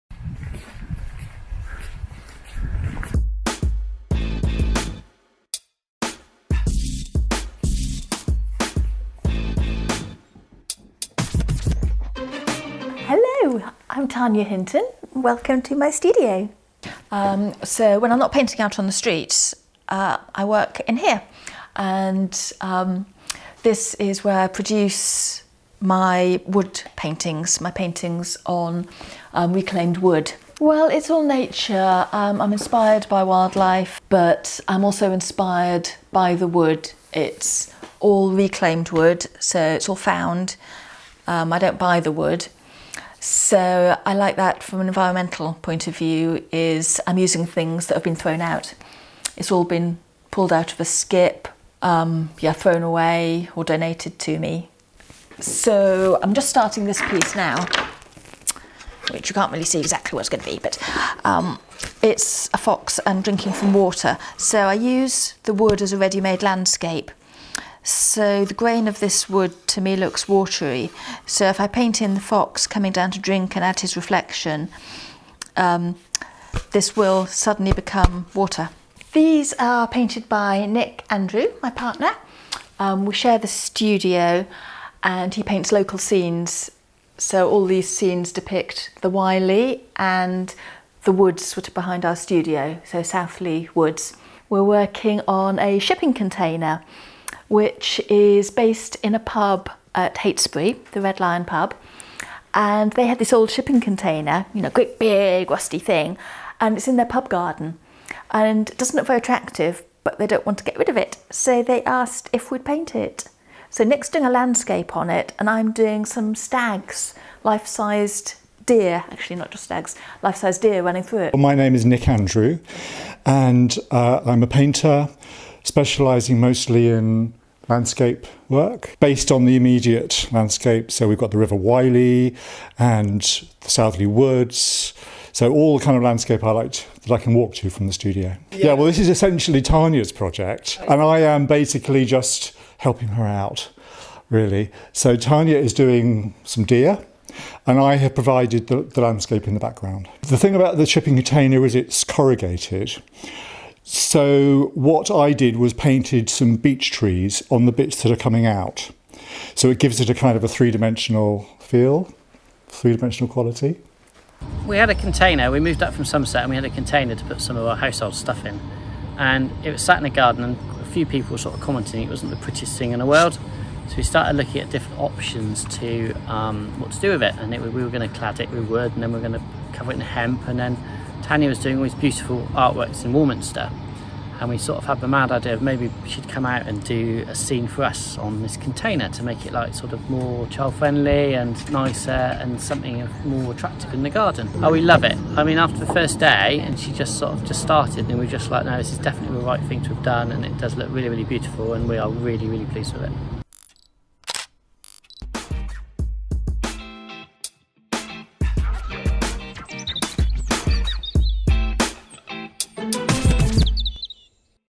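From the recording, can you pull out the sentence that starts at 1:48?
And it doesn't look very attractive, but they don't want to get rid of it.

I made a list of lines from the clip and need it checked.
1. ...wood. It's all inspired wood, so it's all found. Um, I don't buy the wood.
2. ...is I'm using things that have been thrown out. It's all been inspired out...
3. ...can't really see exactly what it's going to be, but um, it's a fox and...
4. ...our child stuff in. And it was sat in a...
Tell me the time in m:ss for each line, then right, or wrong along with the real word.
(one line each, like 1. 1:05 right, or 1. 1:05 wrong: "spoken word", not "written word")
1. 0:36 wrong: "reclaimed", not "inspired"
2. 0:46 wrong: "pulled", not "inspired"
3. 0:59 right
4. 2:47 wrong: "household", not "child".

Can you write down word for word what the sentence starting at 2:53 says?
So we started looking at different options to um, what to do with it.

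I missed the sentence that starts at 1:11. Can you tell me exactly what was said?
So if I paint in the fox coming down to drink and add his reflection, um, this will suddenly become water.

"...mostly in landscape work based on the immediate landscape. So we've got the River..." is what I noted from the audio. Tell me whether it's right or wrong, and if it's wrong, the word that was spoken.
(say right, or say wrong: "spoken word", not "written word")
right.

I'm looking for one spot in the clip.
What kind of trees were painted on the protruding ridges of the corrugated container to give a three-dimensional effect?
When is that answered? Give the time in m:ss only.
2:36.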